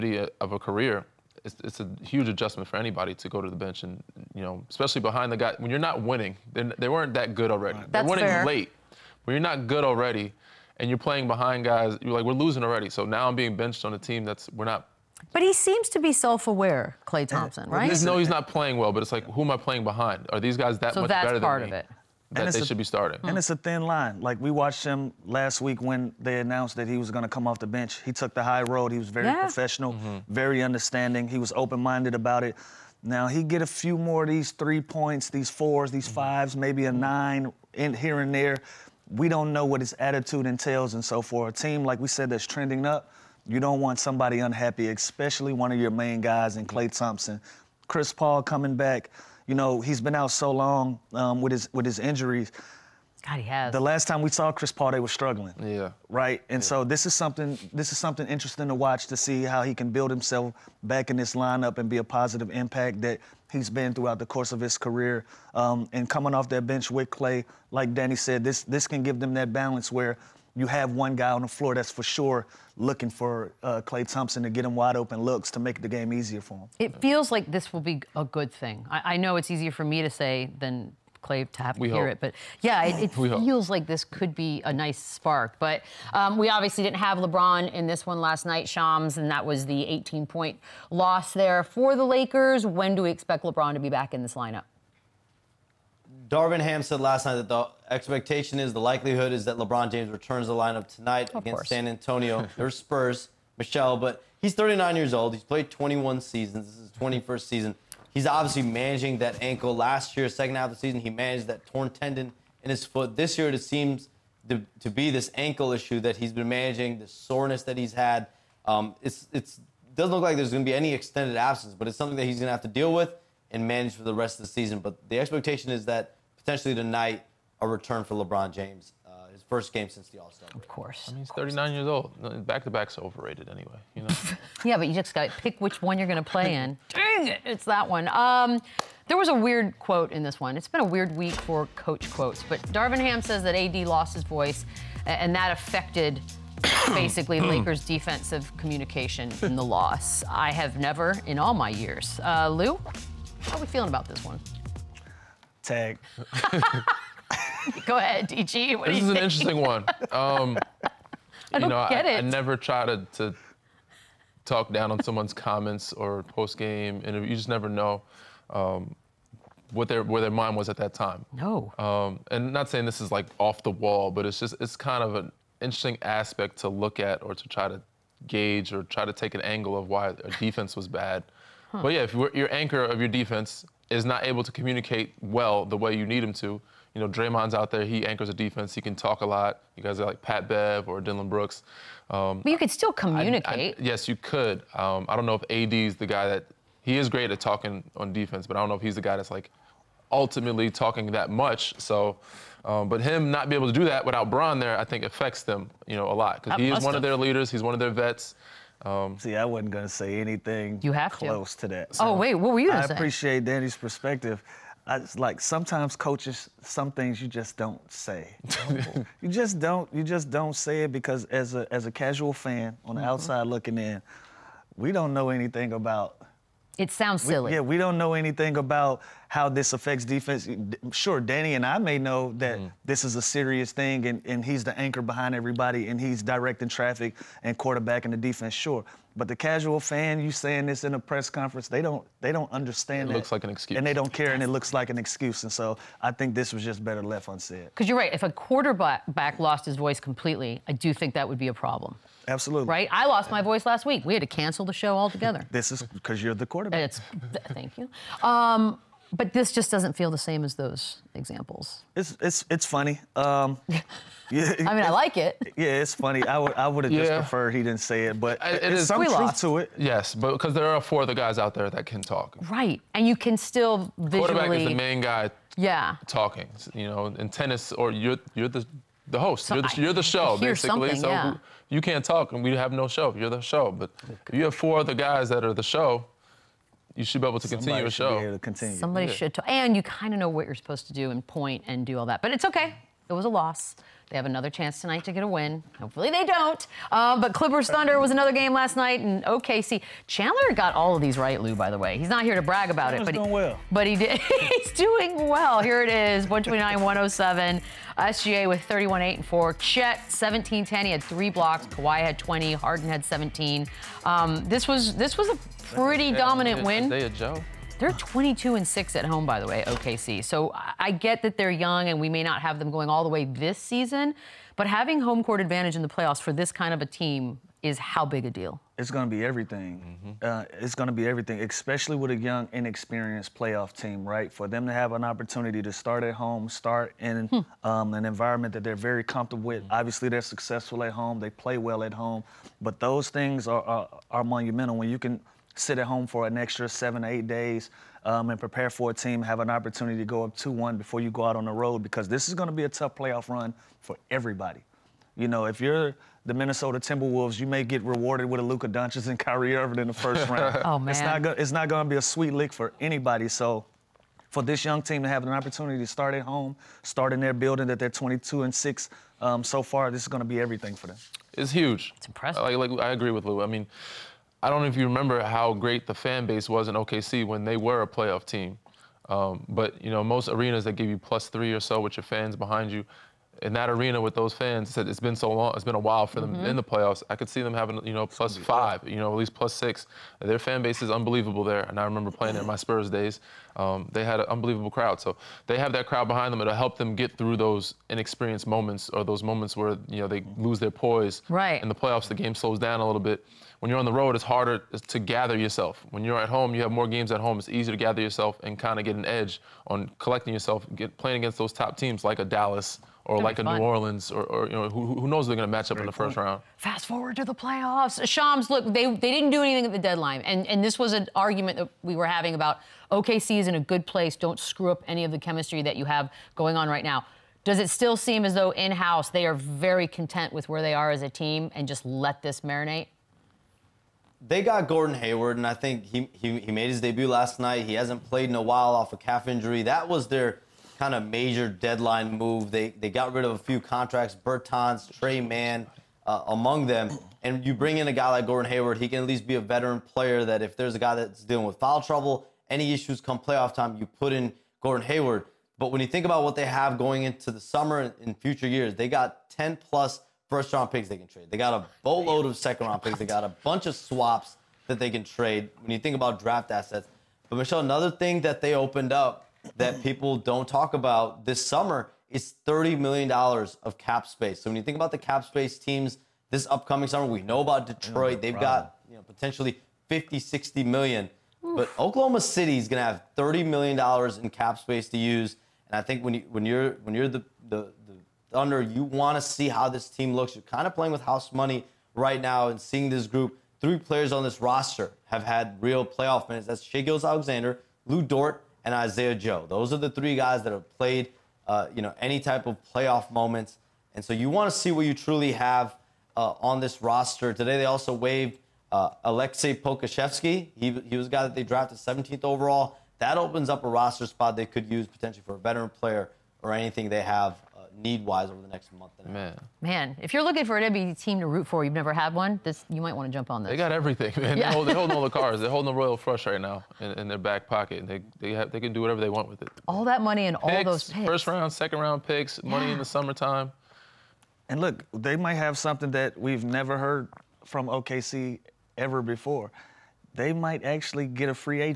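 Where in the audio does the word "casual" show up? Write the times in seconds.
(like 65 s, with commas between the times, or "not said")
221 s, 239 s.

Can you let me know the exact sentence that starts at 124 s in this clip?
But the expectation is that potentially tonight a return for LeBron James.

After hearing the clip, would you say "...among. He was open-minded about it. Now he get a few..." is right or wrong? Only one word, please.
wrong.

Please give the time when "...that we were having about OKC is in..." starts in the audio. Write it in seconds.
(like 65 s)
421 s.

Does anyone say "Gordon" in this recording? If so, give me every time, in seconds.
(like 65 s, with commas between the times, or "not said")
434 s, 448 s, 454 s.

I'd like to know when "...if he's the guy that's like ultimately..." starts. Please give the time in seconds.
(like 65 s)
198 s.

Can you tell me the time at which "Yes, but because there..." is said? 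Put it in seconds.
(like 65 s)
269 s.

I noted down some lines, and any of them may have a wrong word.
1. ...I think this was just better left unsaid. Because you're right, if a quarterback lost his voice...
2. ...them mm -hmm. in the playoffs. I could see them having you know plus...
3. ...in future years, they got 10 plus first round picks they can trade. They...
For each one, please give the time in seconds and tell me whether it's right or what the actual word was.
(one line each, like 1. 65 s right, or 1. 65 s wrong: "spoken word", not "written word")
1. 246 s right
2. 386 s right
3. 458 s right.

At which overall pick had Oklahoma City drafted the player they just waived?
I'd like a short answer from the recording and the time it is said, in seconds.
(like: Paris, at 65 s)
17th, at 511 s.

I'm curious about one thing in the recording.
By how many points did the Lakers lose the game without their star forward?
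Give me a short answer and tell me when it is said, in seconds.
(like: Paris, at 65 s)
18, at 89 s.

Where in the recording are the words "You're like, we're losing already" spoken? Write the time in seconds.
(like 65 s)
12 s.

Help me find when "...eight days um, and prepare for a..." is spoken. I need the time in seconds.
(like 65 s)
347 s.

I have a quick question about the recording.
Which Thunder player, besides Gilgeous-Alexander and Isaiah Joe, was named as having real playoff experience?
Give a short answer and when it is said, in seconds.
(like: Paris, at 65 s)
Lu Dort, at 497 s.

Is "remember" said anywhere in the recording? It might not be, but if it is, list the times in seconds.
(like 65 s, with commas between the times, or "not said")
374 s, 391 s.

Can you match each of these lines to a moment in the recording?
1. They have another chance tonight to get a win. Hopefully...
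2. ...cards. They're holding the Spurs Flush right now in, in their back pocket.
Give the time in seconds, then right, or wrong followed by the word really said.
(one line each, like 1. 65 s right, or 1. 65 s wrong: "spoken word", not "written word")
1. 294 s right
2. 525 s wrong: "Royal", not "Spurs".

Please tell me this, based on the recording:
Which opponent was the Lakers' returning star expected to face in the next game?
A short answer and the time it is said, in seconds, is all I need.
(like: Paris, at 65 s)
San Antonio, at 101 s.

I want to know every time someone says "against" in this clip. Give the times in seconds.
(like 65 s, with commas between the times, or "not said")
101 s, 411 s.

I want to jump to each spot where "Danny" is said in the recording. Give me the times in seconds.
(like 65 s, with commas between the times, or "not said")
67 s, 213 s, 231 s.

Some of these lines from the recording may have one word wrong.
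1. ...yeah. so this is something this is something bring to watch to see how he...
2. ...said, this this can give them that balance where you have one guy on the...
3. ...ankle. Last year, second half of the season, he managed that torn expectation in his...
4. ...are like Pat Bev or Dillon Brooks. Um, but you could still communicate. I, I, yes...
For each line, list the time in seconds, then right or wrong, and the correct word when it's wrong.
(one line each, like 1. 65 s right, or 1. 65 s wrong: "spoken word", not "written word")
1. 56 s wrong: "interesting", not "bring"
2. 68 s right
3. 109 s wrong: "tendon", not "expectation"
4. 189 s right.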